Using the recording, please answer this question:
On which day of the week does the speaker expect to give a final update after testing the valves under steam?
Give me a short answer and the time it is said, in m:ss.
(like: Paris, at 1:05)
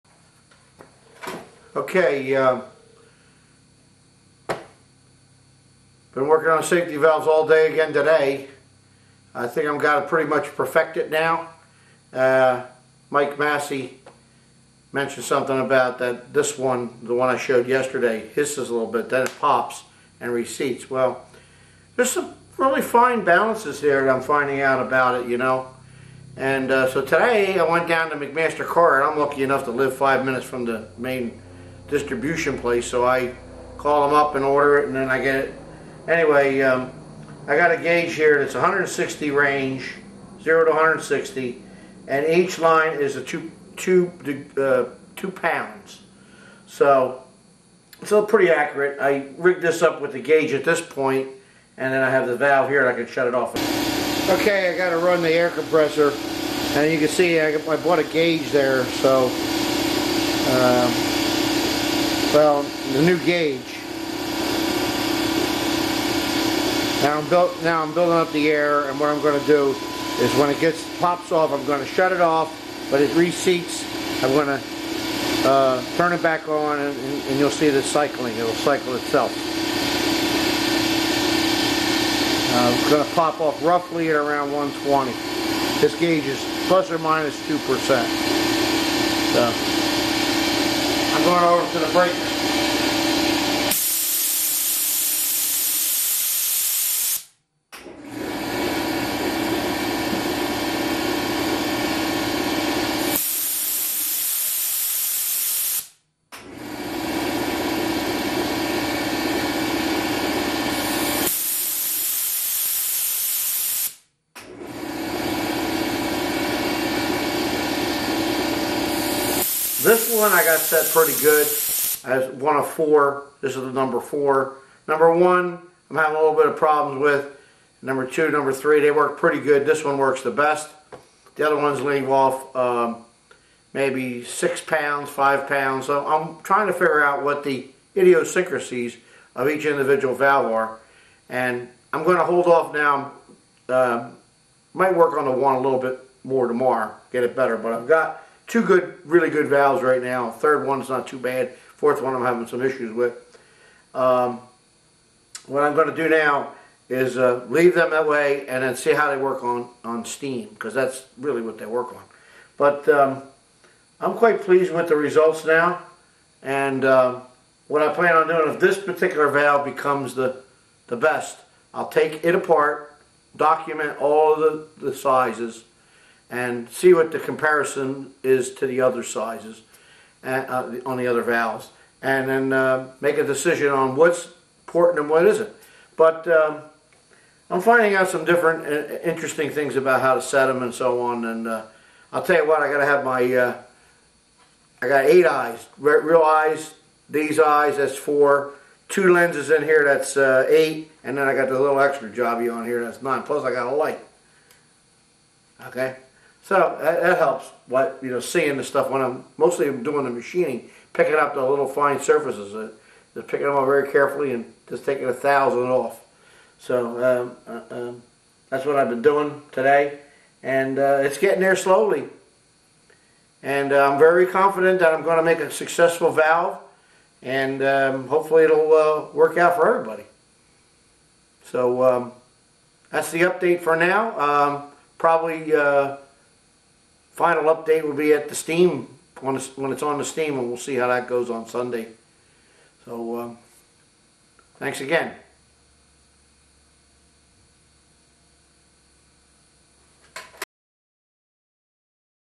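Sunday, at 4:01.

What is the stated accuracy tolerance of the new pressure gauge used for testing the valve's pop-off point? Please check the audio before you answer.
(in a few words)
plus or minus 2%.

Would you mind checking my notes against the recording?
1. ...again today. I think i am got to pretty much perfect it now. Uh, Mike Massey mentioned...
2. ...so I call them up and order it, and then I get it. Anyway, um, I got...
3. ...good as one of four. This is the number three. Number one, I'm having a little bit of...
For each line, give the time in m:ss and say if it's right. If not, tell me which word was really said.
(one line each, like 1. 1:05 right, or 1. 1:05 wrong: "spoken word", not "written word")
1. 0:07 right
2. 0:32 right
3. 2:01 wrong: "four", not "three".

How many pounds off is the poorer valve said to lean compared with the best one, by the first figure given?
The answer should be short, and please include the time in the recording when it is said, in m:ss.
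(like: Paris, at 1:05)
6 pounds, at 2:14.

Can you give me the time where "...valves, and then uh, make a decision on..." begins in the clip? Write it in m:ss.
3:01.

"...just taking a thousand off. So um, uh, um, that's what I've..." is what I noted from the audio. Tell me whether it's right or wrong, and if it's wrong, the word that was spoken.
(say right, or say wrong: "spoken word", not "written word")
right.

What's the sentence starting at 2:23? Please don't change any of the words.
Uh, might work on the one a little bit more tomorrow, get it better.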